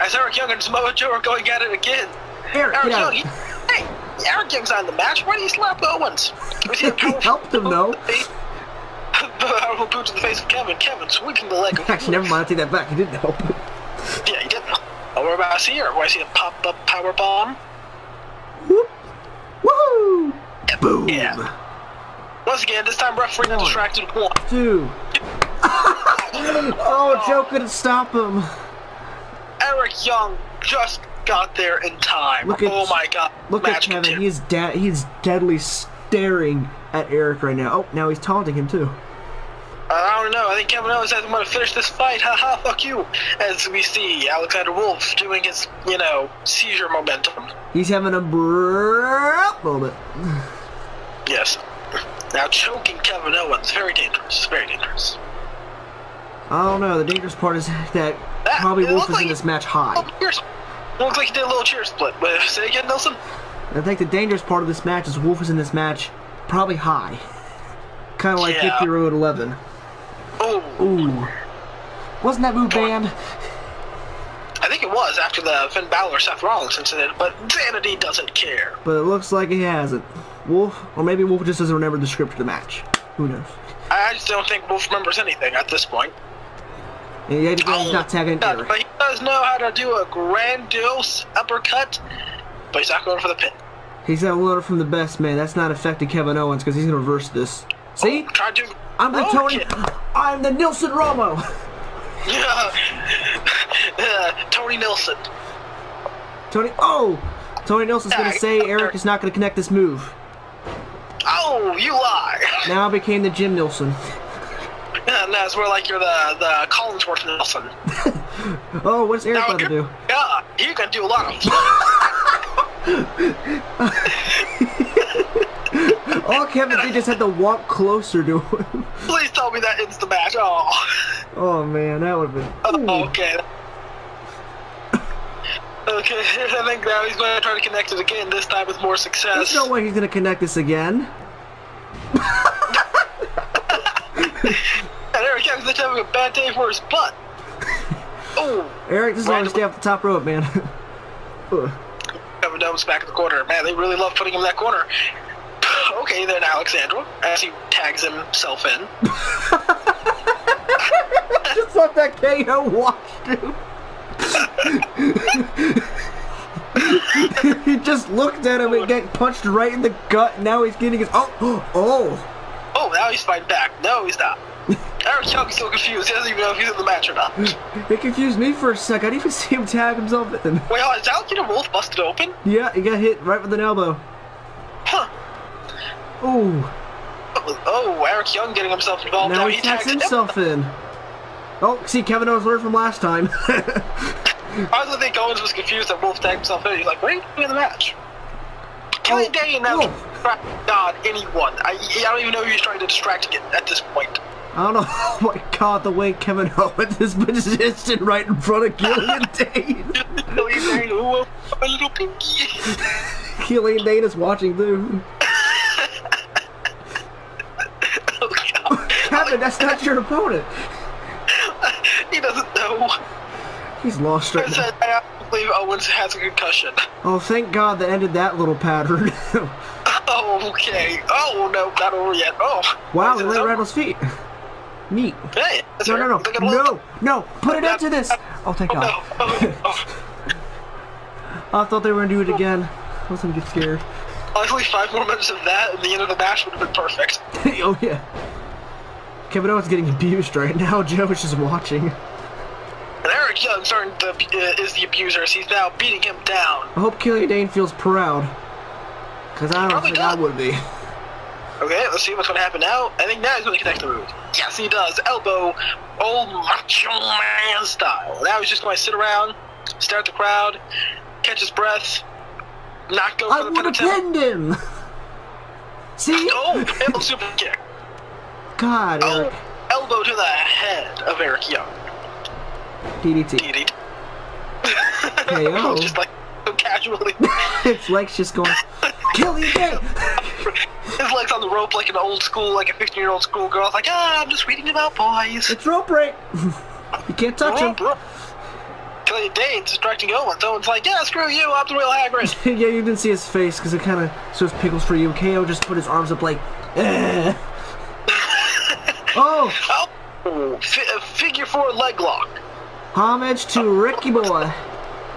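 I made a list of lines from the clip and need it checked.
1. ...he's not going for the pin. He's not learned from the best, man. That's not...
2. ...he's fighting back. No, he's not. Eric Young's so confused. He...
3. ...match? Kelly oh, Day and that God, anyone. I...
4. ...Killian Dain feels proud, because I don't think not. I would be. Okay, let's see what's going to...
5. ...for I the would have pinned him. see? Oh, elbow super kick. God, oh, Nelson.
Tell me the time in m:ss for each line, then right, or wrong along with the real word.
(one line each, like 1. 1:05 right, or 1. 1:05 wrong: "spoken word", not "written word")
1. 1:32 wrong: "loaded", not "learned"
2. 2:53 right
3. 3:17 right
4. 4:16 right
5. 4:33 wrong: "Eric", not "Nelson".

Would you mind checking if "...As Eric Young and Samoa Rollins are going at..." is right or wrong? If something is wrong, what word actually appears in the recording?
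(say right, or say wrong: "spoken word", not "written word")
wrong: "Joe", not "Rollins".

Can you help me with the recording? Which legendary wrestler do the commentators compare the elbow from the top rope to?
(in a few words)
Macho Man.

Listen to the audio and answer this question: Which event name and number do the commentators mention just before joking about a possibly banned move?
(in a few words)
Victory Road 11.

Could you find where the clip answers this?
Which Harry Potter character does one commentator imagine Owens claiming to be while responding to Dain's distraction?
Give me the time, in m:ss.
5:01.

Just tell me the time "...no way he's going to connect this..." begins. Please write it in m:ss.
2:19.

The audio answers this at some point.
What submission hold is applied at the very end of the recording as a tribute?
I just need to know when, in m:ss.
5:10.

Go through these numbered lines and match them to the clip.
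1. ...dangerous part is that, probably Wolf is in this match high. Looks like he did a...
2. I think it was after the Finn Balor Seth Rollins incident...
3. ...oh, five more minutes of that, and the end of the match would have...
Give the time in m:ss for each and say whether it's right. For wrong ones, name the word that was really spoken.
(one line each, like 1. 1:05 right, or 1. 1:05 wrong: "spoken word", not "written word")
1. 0:57 right
2. 1:14 right
3. 4:04 right.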